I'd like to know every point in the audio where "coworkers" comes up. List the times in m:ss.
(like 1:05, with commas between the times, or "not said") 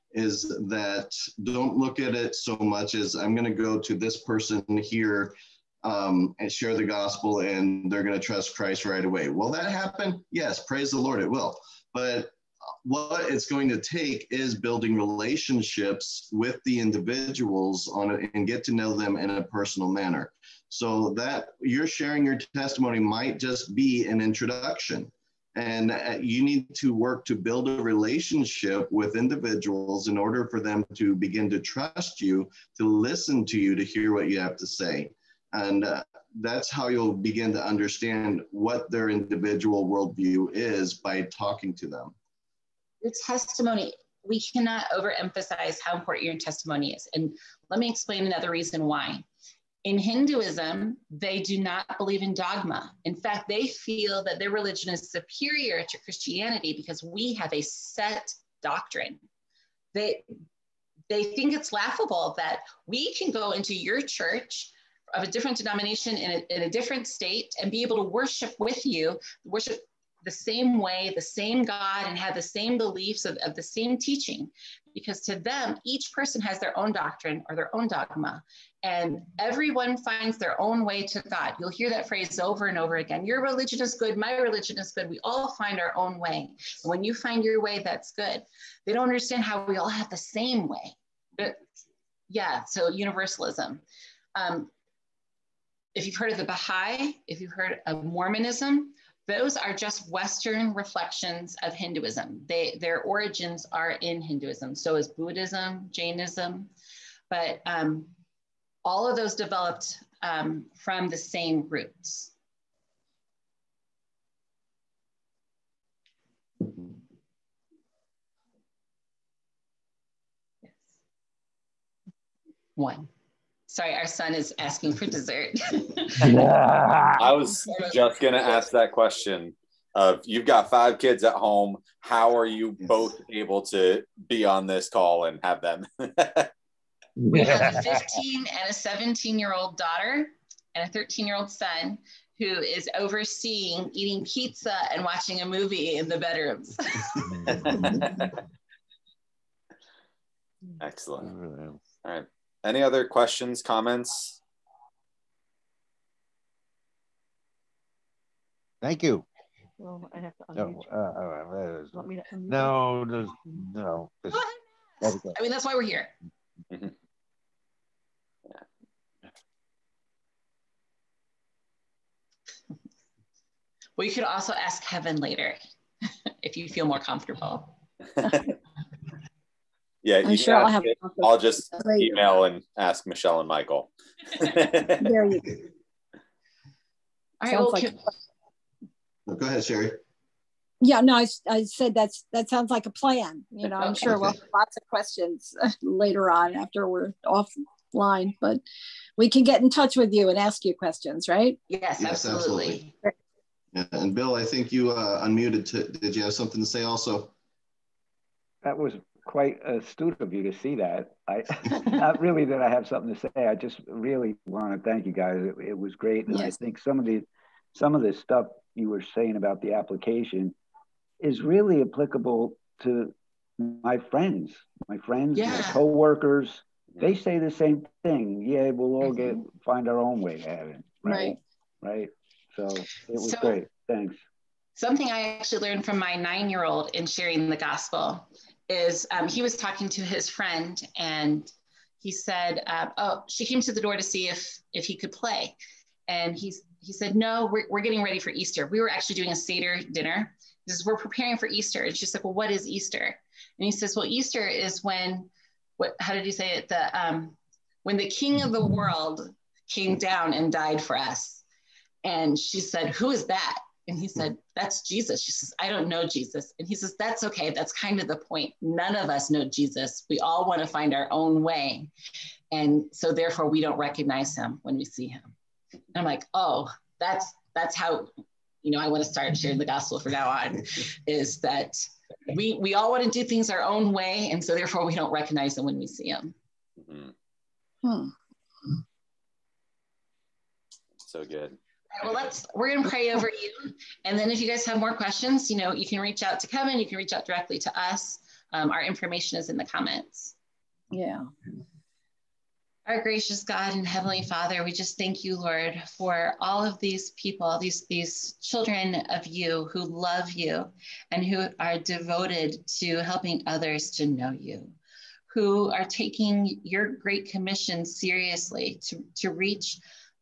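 3:45.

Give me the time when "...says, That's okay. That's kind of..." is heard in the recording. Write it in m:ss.
4:26.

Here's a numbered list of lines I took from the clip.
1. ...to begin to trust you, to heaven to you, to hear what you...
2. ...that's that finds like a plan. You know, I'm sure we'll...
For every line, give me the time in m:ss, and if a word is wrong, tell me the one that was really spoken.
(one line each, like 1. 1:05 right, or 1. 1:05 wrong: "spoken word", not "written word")
1. 0:30 wrong: "listen", not "heaven"
2. 3:11 wrong: "sounds", not "finds".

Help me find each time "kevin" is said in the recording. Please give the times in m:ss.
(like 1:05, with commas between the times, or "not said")
2:54, 4:56.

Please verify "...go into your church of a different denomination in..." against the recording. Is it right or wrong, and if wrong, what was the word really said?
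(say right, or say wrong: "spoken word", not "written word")
right.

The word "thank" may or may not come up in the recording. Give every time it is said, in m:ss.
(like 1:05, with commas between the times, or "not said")
2:38, 3:34, 3:53, 5:04.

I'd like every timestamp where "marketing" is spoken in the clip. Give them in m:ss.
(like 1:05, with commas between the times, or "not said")
not said.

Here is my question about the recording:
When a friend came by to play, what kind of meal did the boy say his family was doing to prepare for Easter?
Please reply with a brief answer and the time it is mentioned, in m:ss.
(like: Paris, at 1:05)
Seder dinner, at 4:09.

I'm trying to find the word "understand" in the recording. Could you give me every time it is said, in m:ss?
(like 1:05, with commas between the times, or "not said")
0:37, 1:29.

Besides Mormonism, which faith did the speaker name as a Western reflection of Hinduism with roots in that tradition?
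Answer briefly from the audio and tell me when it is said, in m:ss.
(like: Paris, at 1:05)
Baha'i, at 1:36.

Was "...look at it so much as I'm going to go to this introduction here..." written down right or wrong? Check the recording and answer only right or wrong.
wrong.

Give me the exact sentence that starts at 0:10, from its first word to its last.
Yes, praise the Lord, it will.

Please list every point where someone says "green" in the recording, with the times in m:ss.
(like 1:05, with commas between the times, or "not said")
not said.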